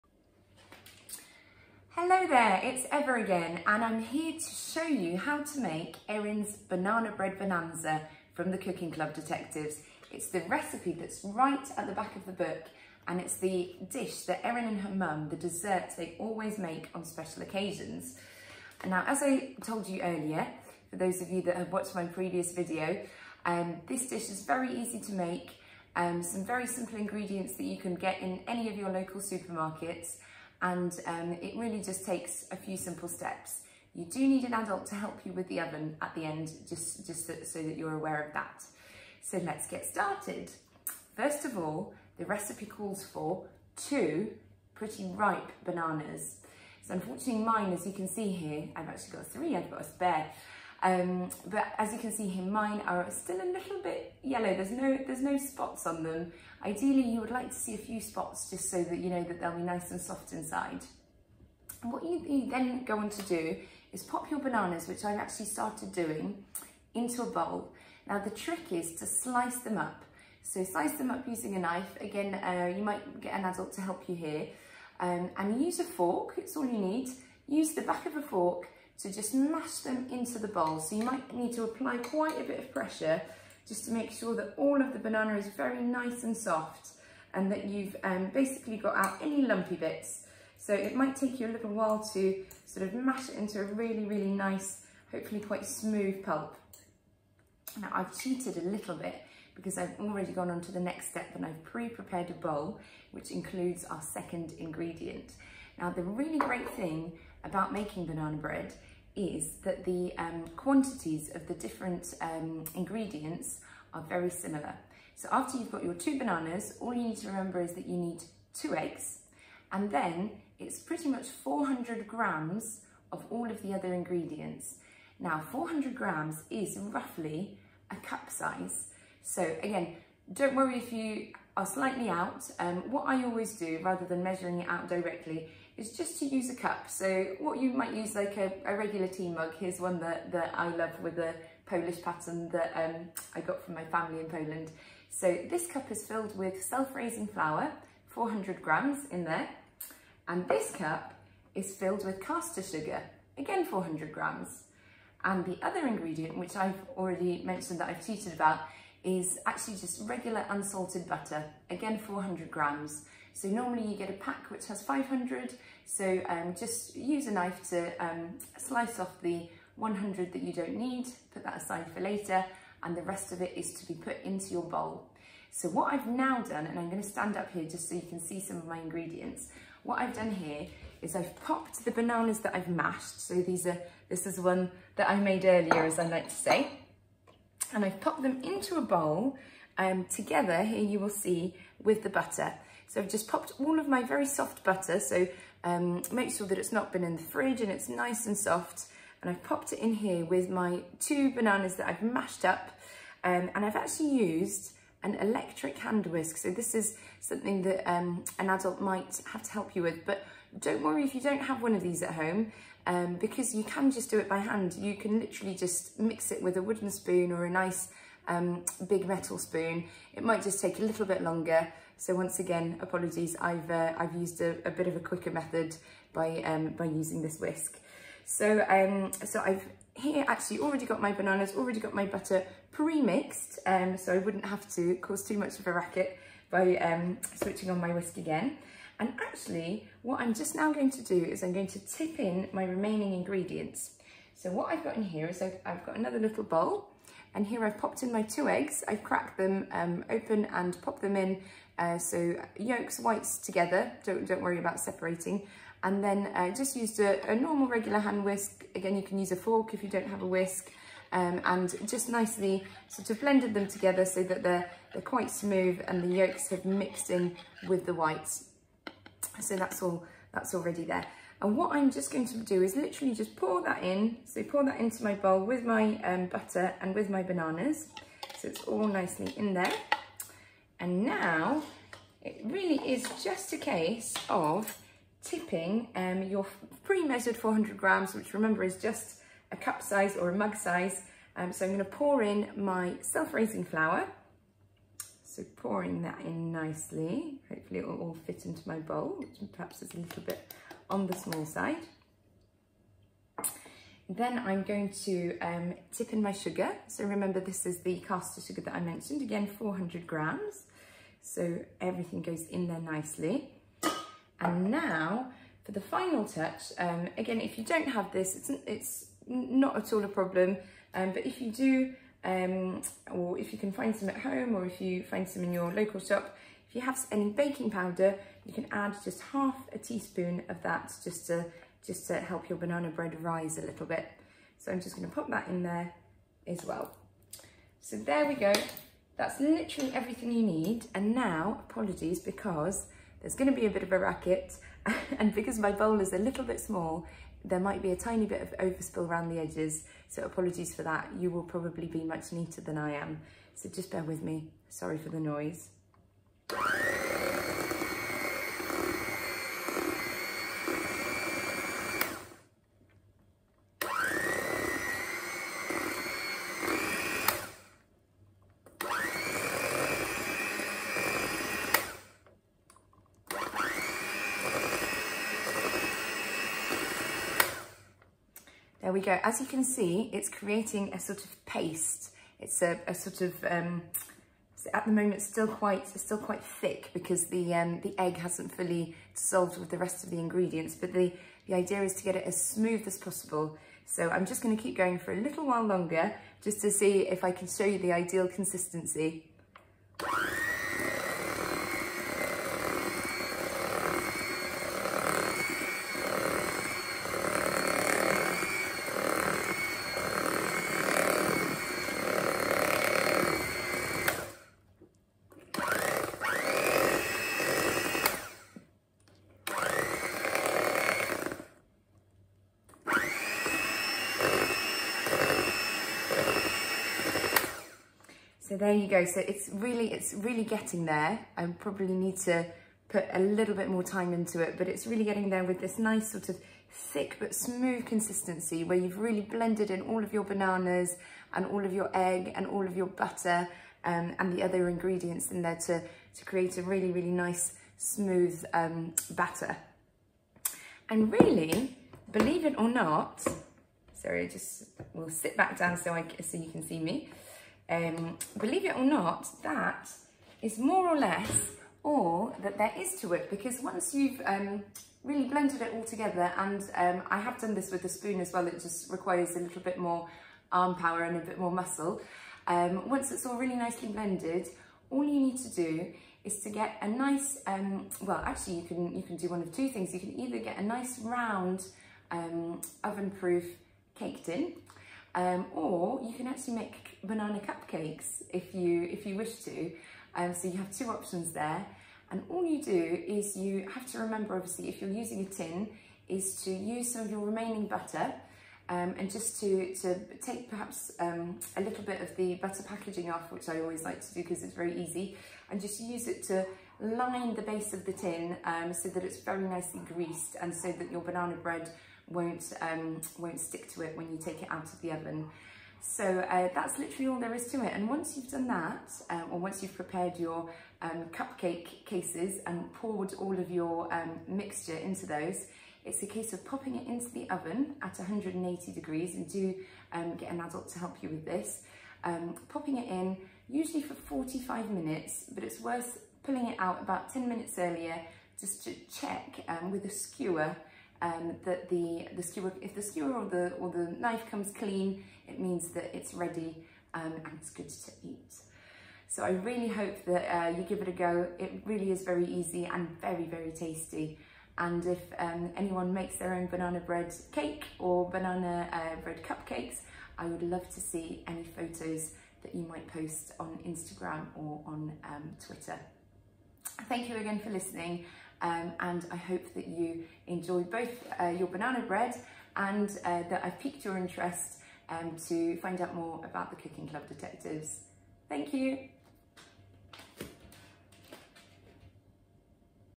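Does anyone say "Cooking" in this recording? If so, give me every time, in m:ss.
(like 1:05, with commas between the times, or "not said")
0:08, 9:36.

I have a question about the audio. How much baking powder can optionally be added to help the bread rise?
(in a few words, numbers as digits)
Half a teaspoon.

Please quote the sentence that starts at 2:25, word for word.
So this cup is filled with self-raising flour, 400 grams in there.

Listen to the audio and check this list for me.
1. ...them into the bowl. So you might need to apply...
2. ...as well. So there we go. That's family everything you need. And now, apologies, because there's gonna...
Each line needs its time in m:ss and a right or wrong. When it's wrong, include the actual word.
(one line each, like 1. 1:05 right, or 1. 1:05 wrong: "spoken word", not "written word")
1. 1:19 right
2. 5:36 wrong: "literally", not "family".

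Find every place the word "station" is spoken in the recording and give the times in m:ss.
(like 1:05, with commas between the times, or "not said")
not said.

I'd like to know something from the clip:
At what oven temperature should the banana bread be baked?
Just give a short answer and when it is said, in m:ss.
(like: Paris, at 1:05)
180 degrees, at 8:47.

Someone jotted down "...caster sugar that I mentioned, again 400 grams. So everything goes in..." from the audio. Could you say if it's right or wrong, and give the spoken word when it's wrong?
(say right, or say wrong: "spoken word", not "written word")
right.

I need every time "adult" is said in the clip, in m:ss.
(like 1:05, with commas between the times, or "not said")
0:34, 1:13, 3:28, 8:50.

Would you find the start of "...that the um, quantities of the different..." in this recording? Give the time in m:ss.
1:49.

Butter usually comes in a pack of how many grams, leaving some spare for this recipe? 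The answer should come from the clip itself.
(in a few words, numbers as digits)
500.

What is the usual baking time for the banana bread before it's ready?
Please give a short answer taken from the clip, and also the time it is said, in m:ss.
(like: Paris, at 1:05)
45 minutes, at 8:53.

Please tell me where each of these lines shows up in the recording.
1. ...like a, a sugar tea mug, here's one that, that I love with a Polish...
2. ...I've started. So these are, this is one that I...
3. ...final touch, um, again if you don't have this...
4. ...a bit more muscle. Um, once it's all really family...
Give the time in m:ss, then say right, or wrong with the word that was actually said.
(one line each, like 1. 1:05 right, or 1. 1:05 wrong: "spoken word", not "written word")
1. 2:18 wrong: "regular", not "sugar"
2. 3:02 wrong: "mashed", not "started"
3. 5:15 right
4. 7:51 wrong: "nicely", not "family".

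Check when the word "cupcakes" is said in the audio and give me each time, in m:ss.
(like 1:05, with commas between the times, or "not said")
8:07, 8:41, 9:19.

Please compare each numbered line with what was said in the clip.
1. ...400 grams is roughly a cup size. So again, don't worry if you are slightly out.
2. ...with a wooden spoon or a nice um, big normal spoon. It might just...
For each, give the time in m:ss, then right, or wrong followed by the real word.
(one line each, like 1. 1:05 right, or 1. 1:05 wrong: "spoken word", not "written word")
1. 2:05 right
2. 3:36 wrong: "metal", not "normal".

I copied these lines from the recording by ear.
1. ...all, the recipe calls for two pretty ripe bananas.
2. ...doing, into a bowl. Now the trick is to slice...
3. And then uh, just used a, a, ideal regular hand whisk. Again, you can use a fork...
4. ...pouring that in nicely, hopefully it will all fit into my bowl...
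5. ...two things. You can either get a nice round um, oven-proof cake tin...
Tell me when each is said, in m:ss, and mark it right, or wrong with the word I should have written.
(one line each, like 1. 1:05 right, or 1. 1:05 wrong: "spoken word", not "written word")
1. 0:41 right
2. 1:05 right
3. 4:15 wrong: "normal", not "ideal"
4. 4:55 right
5. 7:59 right.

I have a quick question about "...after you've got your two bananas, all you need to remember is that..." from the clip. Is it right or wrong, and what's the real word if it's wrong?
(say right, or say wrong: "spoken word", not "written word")
right.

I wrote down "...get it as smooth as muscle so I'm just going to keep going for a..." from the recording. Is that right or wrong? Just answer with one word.
wrong.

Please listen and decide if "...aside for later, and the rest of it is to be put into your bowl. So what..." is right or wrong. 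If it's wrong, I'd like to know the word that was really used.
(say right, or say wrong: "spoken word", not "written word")
right.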